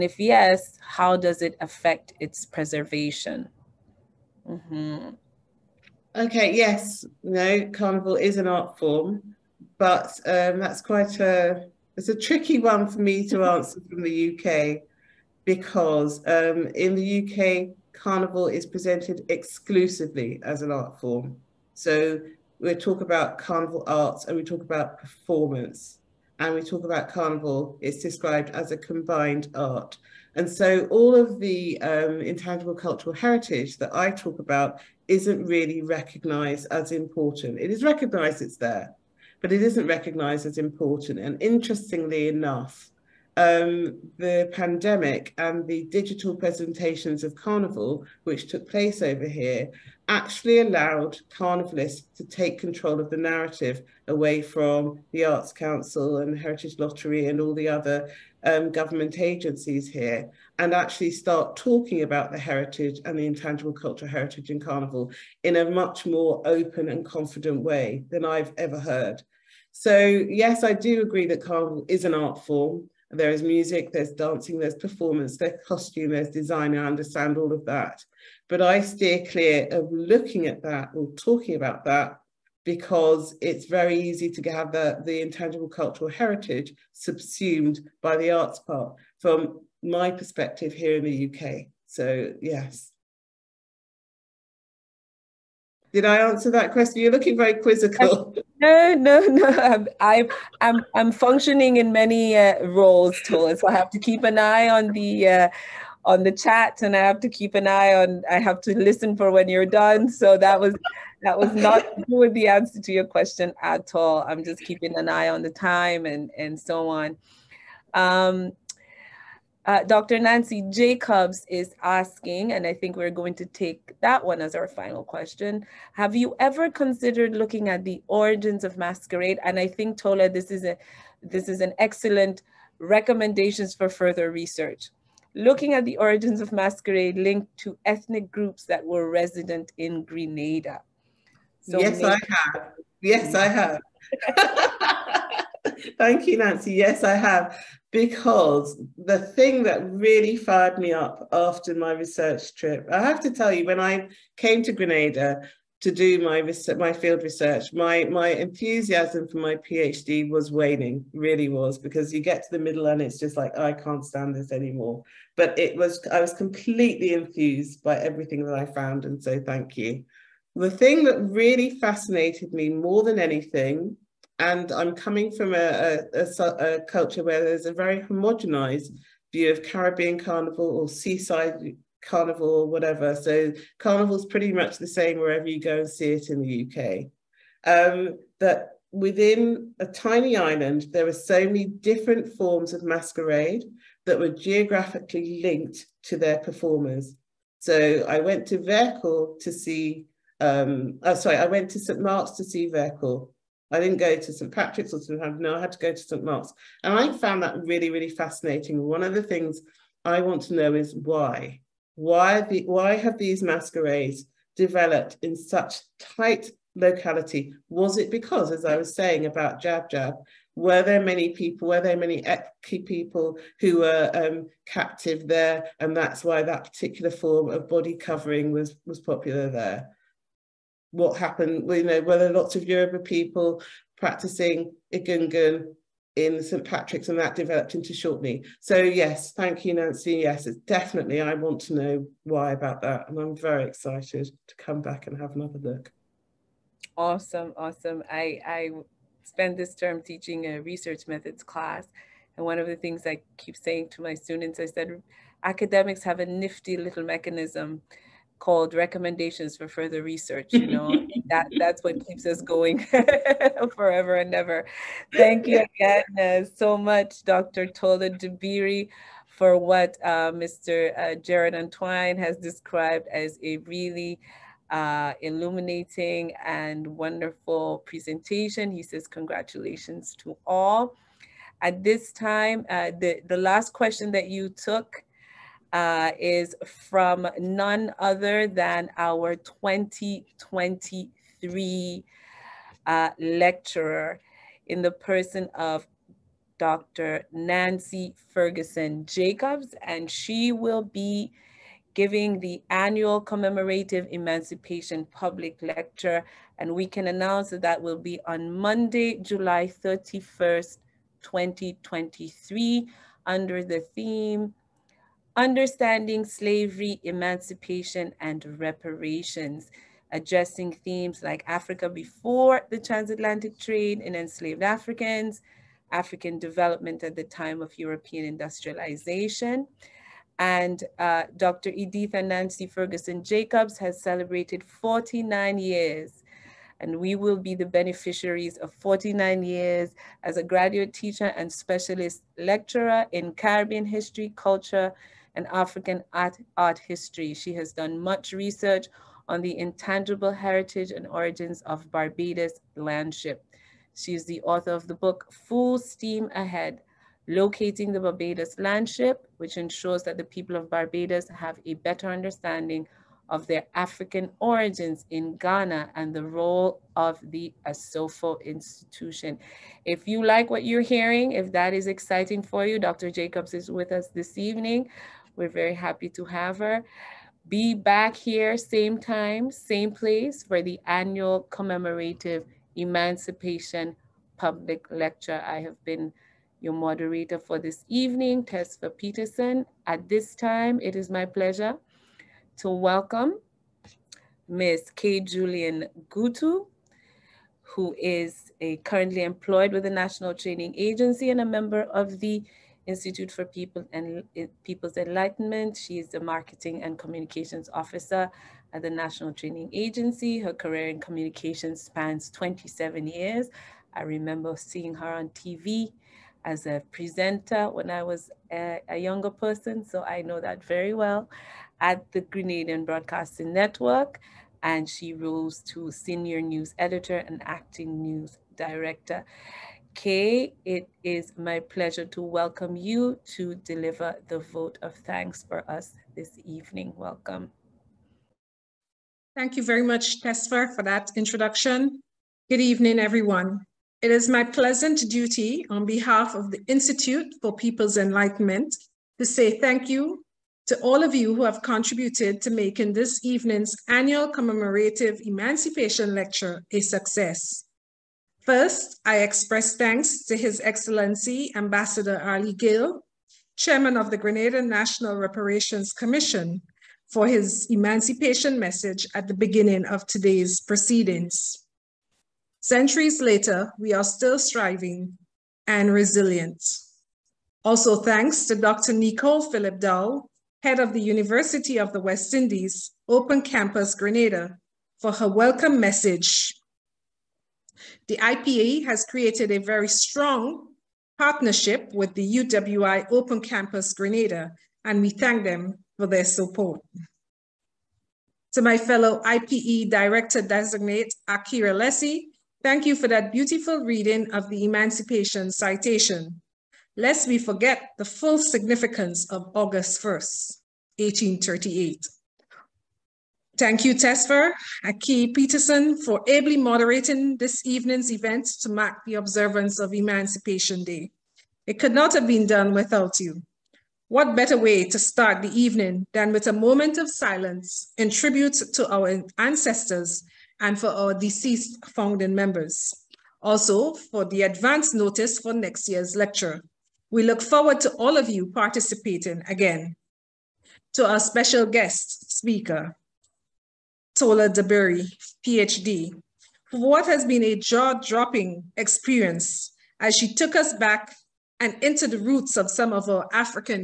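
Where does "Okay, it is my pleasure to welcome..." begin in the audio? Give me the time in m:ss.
7:09.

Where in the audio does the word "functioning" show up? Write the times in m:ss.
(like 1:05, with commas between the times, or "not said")
1:41.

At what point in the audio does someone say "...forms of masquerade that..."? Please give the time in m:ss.
3:12.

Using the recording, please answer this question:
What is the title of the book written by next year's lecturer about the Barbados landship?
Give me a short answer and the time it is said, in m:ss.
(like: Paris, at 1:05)
Full Steam Ahead, at 5:55.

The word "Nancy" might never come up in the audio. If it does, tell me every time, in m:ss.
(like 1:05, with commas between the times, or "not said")
2:00, 2:26, 3:59, 4:57, 5:32.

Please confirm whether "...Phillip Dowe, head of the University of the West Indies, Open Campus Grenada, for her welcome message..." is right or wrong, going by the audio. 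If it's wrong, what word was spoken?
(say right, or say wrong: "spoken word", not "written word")
right.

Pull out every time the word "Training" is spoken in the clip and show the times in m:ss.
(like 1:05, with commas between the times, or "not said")
6:40, 6:49.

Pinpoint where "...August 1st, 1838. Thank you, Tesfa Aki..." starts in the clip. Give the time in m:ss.
8:29.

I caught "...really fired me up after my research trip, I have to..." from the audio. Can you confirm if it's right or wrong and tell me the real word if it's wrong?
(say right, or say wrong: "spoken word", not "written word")
right.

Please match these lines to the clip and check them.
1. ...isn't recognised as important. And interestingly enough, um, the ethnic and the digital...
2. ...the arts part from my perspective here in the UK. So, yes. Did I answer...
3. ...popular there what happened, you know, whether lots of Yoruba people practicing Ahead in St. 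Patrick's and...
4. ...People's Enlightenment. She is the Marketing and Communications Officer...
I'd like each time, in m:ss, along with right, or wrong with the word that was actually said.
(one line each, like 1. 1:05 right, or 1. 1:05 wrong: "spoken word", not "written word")
1. 0:39 wrong: "pandemic", not "ethnic"
2. 1:28 right
3. 3:48 wrong: "Egungun", not "Ahead"
4. 6:44 right.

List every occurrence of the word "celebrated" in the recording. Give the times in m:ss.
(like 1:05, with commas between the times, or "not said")
5:34.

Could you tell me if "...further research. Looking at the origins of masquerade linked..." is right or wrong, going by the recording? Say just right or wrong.
right.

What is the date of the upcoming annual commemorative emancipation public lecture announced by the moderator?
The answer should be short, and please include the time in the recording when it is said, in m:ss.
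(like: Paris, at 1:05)
Monday, July 31st, 2023, at 5:08.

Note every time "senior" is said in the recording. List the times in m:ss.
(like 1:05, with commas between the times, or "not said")
7:05.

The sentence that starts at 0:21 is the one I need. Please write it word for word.
So we talk about carnival arts and we talk about performance and we talk about carnival, it's described as a combined art.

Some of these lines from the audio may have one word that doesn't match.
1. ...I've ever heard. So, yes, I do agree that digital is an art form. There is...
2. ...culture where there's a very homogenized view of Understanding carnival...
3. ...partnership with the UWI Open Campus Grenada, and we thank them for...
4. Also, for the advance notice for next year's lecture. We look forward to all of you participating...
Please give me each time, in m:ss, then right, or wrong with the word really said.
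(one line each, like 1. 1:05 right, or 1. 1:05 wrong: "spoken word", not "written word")
1. 1:08 wrong: "carnival", not "digital"
2. 2:56 wrong: "Caribbean", not "Understanding"
3. 8:11 right
4. 8:53 right.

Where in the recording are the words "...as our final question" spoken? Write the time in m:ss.
2:04.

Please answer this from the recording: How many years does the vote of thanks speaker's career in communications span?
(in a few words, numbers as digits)
27.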